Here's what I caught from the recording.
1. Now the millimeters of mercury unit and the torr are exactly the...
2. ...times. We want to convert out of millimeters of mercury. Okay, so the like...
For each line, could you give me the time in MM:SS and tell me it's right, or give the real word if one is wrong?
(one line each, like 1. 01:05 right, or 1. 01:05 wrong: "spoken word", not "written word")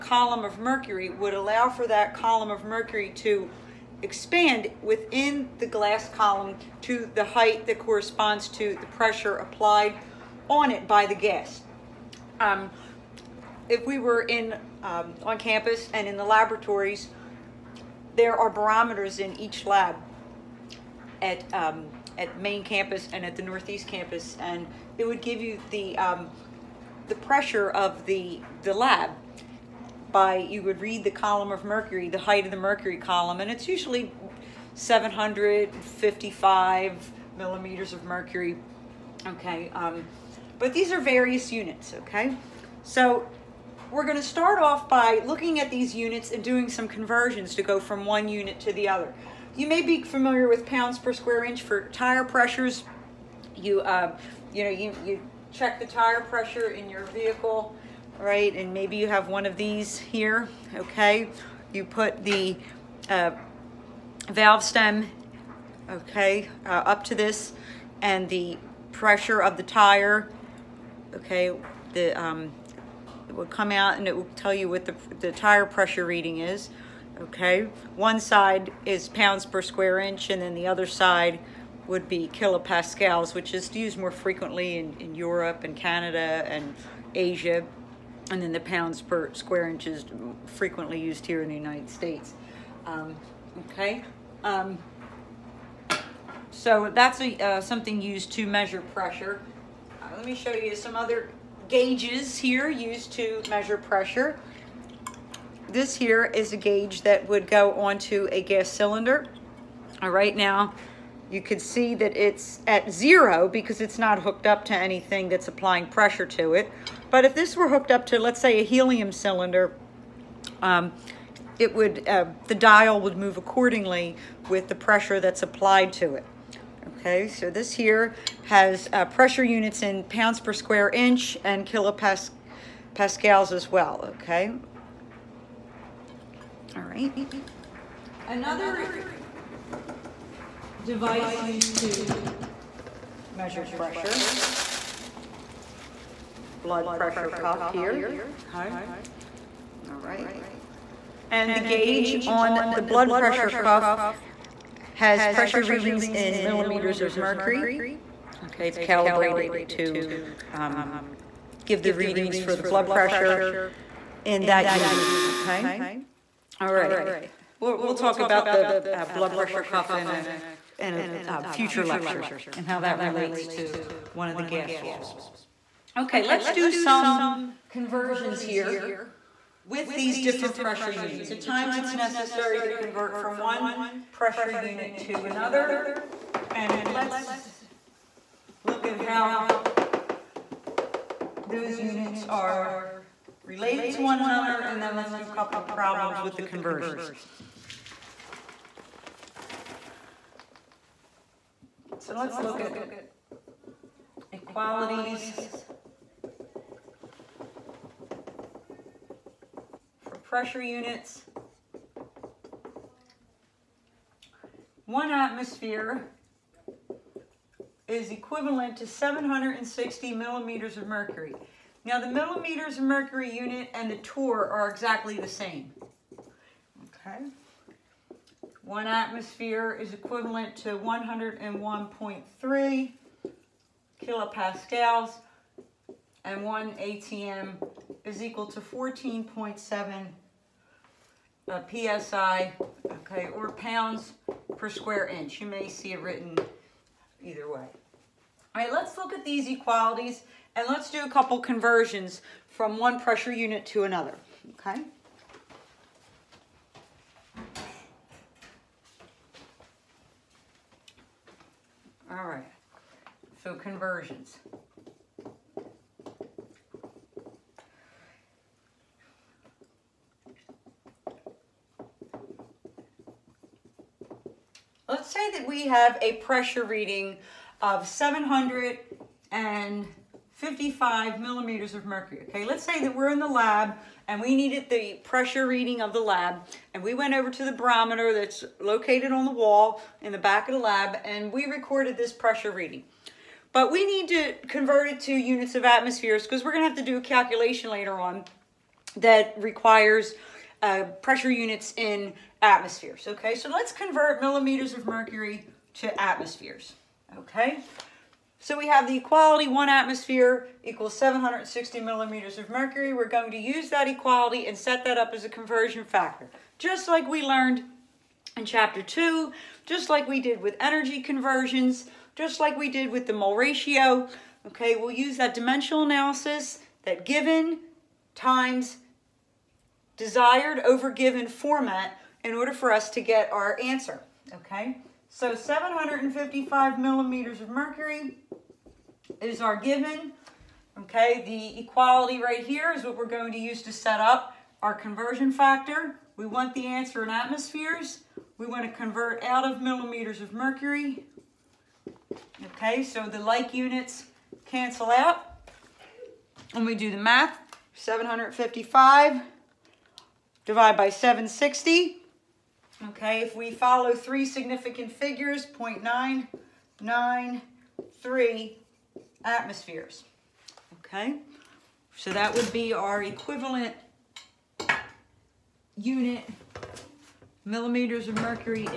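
1. 03:41 right
2. 05:47 wrong: "atmospheres", not "times".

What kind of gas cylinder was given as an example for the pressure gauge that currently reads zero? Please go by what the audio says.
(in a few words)
helium.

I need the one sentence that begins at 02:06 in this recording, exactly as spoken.
Okay, so this here has uh, pressure units in pounds per square inch and kilopascals as well, okay?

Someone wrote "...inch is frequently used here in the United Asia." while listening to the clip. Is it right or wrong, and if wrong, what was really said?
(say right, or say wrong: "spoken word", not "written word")
wrong: "States", not "Asia".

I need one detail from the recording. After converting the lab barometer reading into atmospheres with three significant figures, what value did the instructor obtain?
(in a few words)
0.993 atmospheres.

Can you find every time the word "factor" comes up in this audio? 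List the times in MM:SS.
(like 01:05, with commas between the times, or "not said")
05:15, 05:45.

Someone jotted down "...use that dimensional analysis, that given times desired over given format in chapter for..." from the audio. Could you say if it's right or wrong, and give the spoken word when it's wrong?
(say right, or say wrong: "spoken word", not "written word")
wrong: "order", not "chapter".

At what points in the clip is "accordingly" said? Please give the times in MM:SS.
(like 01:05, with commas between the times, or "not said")
02:03.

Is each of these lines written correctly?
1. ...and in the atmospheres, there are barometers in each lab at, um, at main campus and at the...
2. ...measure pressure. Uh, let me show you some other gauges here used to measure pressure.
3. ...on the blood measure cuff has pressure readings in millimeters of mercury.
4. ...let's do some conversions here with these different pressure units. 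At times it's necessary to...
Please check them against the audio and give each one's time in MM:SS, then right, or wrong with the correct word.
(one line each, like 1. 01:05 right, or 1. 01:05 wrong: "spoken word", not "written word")
1. 00:15 wrong: "laboratories", not "atmospheres"
2. 01:38 right
3. 02:32 wrong: "pressure", not "measure"
4. 02:56 right.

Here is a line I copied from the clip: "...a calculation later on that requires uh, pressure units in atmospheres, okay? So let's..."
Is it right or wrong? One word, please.
right.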